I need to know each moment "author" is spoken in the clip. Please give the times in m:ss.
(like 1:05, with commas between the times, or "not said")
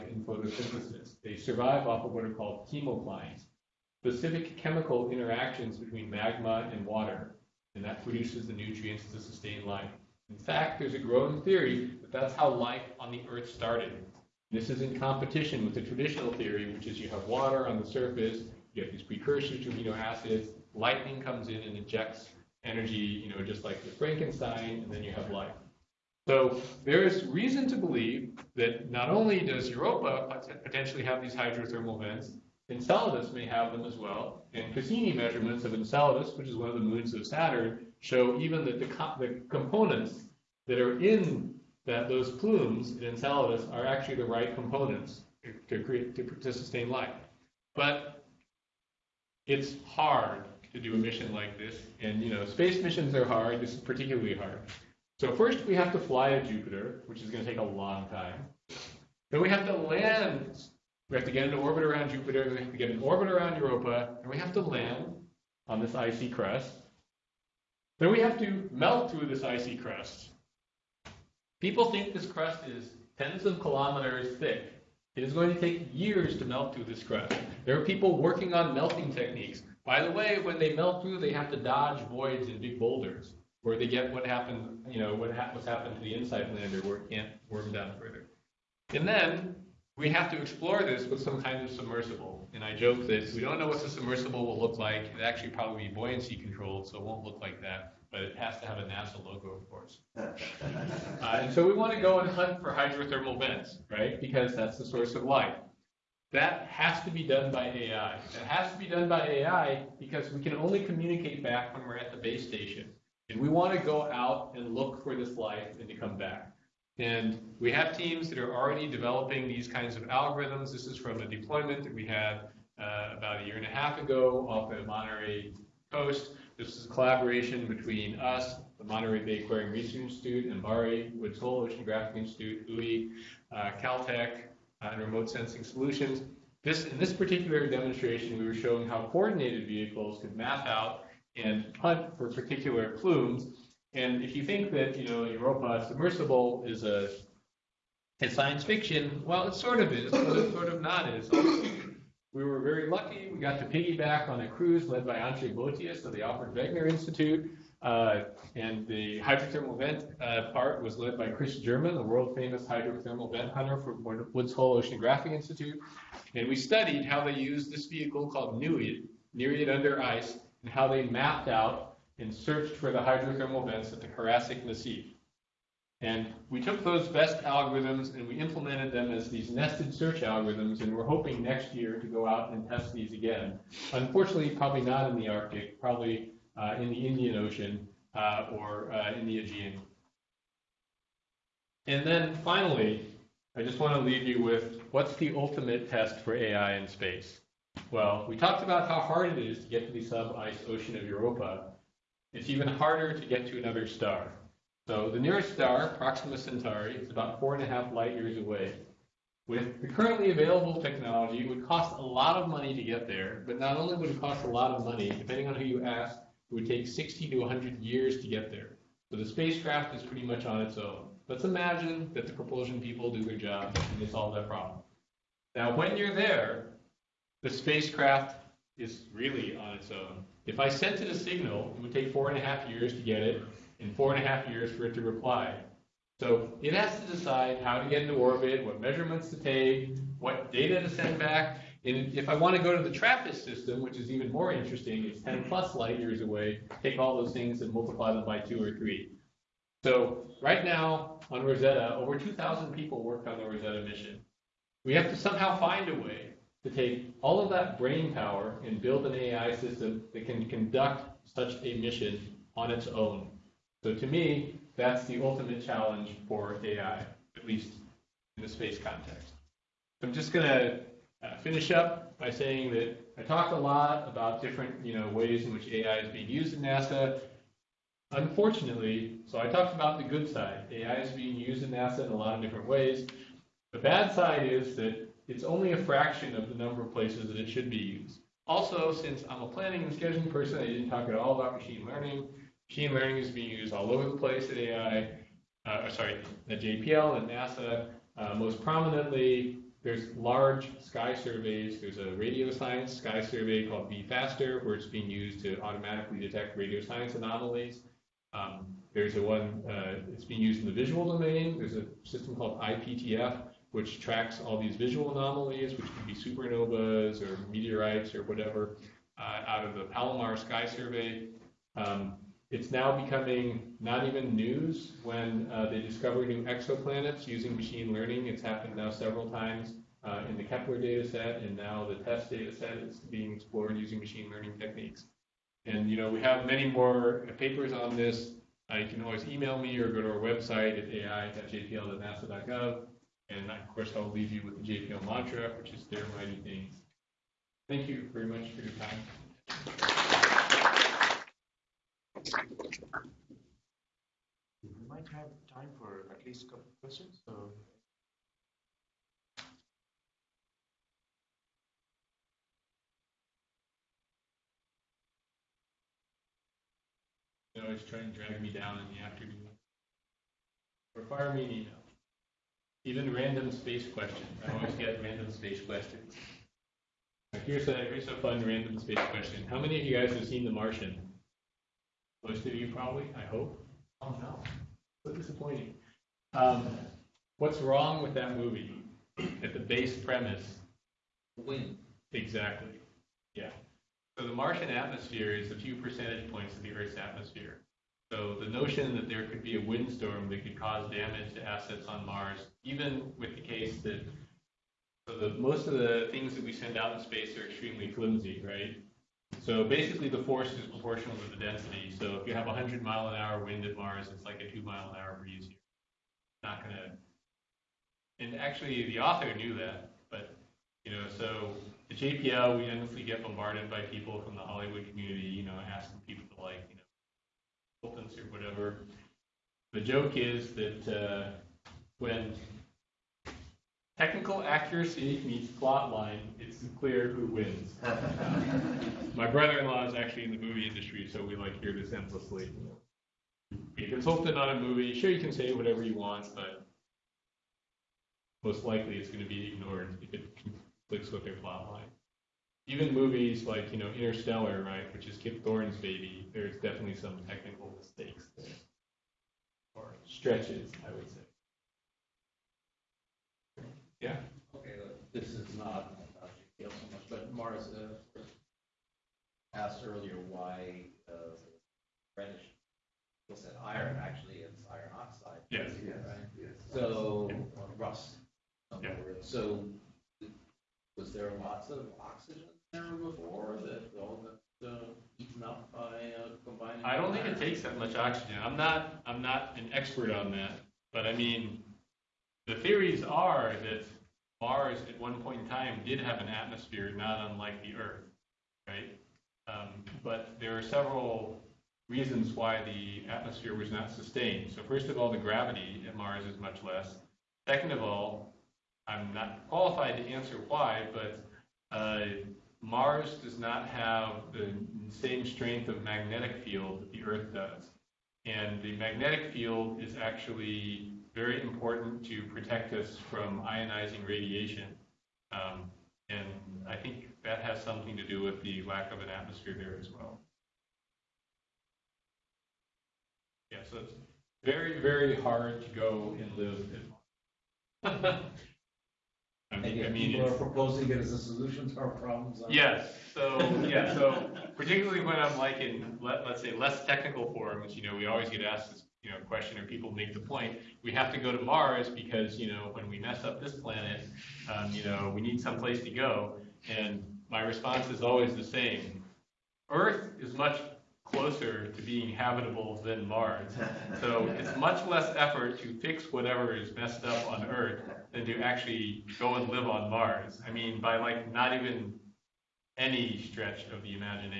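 6:58.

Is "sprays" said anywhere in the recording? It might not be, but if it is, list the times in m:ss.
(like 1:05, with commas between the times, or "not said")
not said.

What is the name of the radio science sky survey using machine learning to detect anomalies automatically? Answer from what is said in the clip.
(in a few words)
V-FASTR.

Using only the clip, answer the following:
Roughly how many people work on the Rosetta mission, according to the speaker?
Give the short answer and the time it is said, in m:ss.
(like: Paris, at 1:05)
over 2,000, at 4:11.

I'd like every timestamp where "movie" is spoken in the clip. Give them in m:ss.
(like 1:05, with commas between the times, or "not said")
6:28, 7:20, 7:24, 7:32.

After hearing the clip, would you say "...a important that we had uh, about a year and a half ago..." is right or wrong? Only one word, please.
wrong.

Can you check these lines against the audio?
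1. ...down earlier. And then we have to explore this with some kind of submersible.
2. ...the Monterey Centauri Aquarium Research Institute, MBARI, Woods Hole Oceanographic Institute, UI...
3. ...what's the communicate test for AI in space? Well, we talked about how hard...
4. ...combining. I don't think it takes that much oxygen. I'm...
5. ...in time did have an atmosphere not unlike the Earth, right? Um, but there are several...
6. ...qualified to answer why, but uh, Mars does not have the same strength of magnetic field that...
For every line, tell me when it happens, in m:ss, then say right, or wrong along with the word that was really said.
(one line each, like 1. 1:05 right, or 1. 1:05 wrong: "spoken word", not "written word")
1. 1:27 wrong: "further", not "earlier"
2. 2:08 wrong: "Bay", not "Centauri"
3. 3:14 wrong: "ultimate", not "communicate"
4. 8:06 right
5. 8:15 right
6. 8:29 right.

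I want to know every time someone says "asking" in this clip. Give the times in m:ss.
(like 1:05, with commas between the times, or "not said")
7:05.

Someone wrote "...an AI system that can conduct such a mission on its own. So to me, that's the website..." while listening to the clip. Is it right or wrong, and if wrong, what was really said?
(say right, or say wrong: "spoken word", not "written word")
wrong: "ultimate", not "website".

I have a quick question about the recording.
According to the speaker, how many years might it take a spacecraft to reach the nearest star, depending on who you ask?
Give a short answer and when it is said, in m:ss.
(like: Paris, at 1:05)
60 to 100 years, at 3:36.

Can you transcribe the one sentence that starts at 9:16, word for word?
And my response is always the same.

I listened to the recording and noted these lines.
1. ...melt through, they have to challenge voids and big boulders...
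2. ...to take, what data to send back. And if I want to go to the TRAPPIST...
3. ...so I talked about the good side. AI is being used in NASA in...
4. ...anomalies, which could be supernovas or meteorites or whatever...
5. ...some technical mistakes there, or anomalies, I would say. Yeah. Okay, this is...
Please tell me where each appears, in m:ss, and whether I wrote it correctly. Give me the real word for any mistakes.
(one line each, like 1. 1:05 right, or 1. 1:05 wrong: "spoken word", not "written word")
1. 1:20 wrong: "dodge", not "challenge"
2. 3:59 right
3. 4:39 right
4. 5:15 right
5. 7:36 wrong: "stretches", not "anomalies".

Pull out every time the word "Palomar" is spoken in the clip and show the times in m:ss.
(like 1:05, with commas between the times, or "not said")
5:19.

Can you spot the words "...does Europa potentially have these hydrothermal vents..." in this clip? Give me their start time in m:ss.
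0:29.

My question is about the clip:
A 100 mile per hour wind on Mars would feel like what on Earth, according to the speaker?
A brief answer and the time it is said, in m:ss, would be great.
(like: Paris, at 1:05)
2 mile an hour breeze, at 6:54.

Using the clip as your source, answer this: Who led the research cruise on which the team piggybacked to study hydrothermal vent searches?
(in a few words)
Antje Boetius.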